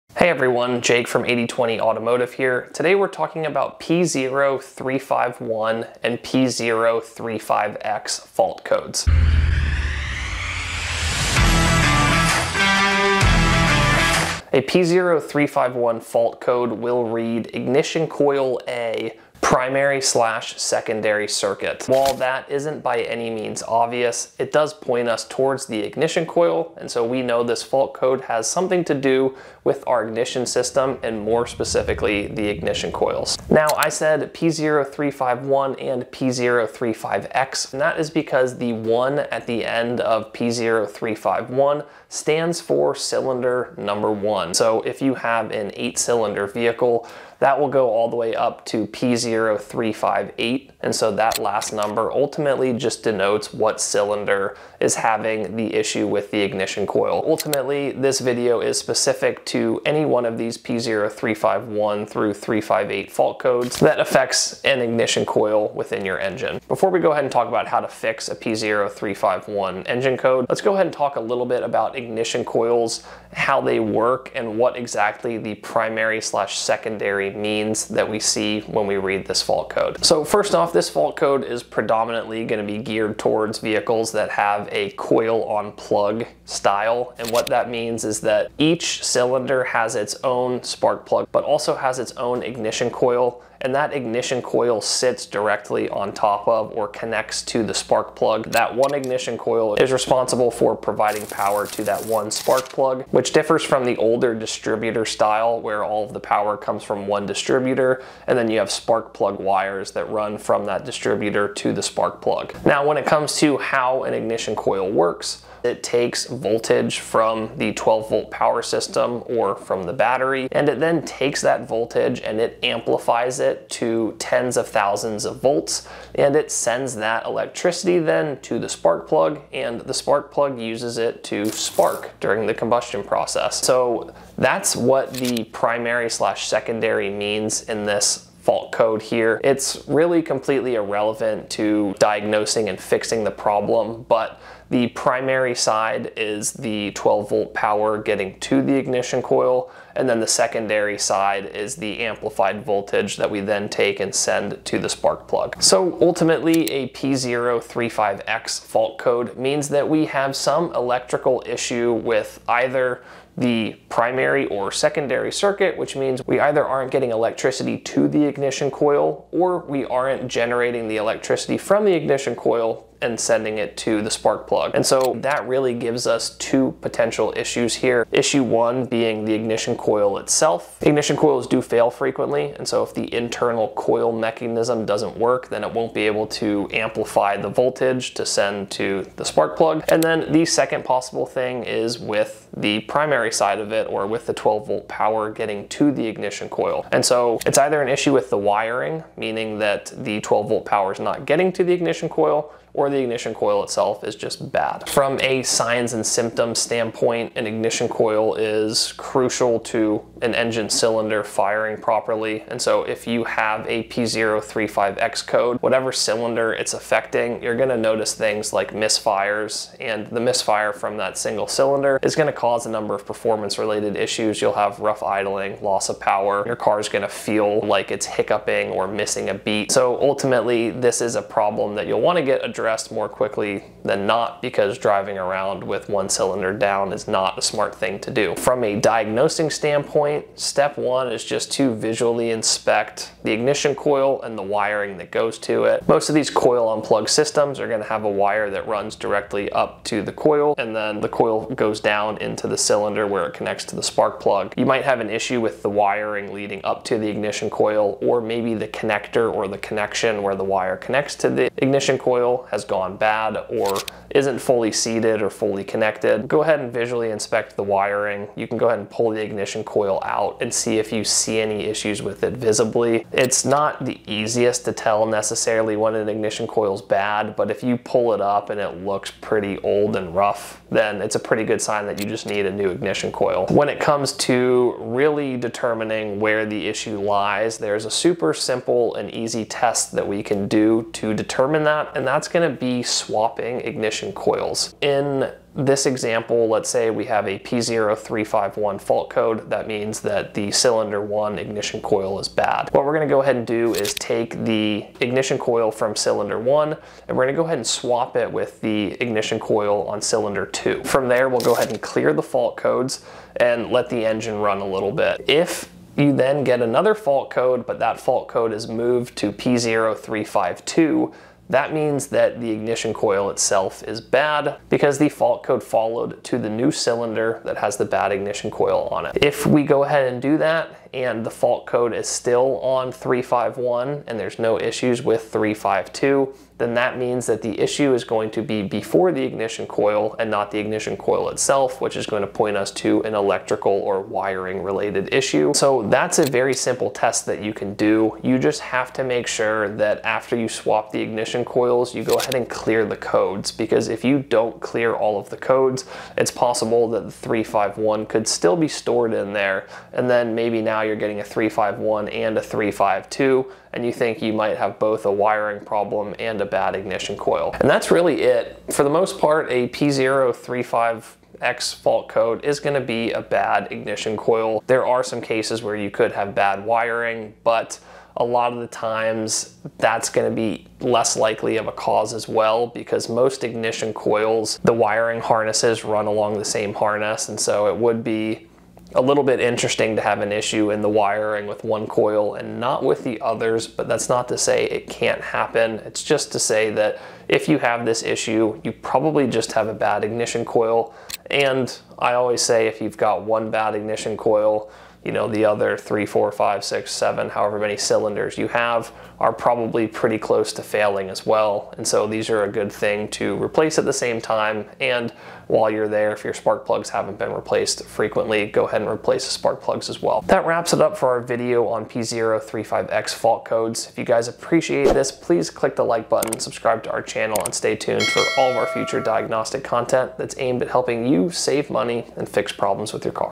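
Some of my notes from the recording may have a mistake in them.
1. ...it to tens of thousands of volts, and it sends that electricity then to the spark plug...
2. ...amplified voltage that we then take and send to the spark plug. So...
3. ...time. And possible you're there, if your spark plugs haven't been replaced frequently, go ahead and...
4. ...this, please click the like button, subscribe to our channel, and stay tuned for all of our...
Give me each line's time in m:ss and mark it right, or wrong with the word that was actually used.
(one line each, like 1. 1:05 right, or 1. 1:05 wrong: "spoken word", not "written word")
1. 2:03 right
2. 2:31 right
3. 6:54 wrong: "while", not "possible"
4. 7:04 right.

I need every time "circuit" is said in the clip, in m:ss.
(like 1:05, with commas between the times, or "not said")
0:21, 2:45.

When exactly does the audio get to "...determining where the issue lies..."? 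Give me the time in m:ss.
4:45.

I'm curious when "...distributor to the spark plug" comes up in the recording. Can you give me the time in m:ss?
1:50.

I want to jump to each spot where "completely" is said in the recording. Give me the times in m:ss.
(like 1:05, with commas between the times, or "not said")
2:20.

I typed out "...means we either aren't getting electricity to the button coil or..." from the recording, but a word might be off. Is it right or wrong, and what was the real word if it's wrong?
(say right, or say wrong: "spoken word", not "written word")
wrong: "ignition", not "button".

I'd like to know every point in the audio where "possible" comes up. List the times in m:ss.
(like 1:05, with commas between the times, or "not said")
3:10, 5:56.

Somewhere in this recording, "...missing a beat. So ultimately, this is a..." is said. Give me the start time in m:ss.
3:48.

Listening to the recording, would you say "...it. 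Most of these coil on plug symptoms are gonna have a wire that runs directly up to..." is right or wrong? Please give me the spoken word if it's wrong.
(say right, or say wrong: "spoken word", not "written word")
wrong: "systems", not "symptoms".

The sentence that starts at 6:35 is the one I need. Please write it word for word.
It's just to say that if you have this issue, you probably just have a bad ignition coil.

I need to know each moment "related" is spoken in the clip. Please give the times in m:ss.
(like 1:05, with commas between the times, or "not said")
3:43, 5:44.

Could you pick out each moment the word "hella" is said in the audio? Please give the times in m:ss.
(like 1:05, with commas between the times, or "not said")
not said.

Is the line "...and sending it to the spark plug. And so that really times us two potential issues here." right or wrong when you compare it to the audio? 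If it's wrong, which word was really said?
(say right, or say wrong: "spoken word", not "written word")
wrong: "gives", not "times".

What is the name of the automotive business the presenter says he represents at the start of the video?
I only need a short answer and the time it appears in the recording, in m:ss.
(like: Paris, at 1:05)
8020 Automotive, at 0:01.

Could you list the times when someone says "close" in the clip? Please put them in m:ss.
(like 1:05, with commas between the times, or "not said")
6:50.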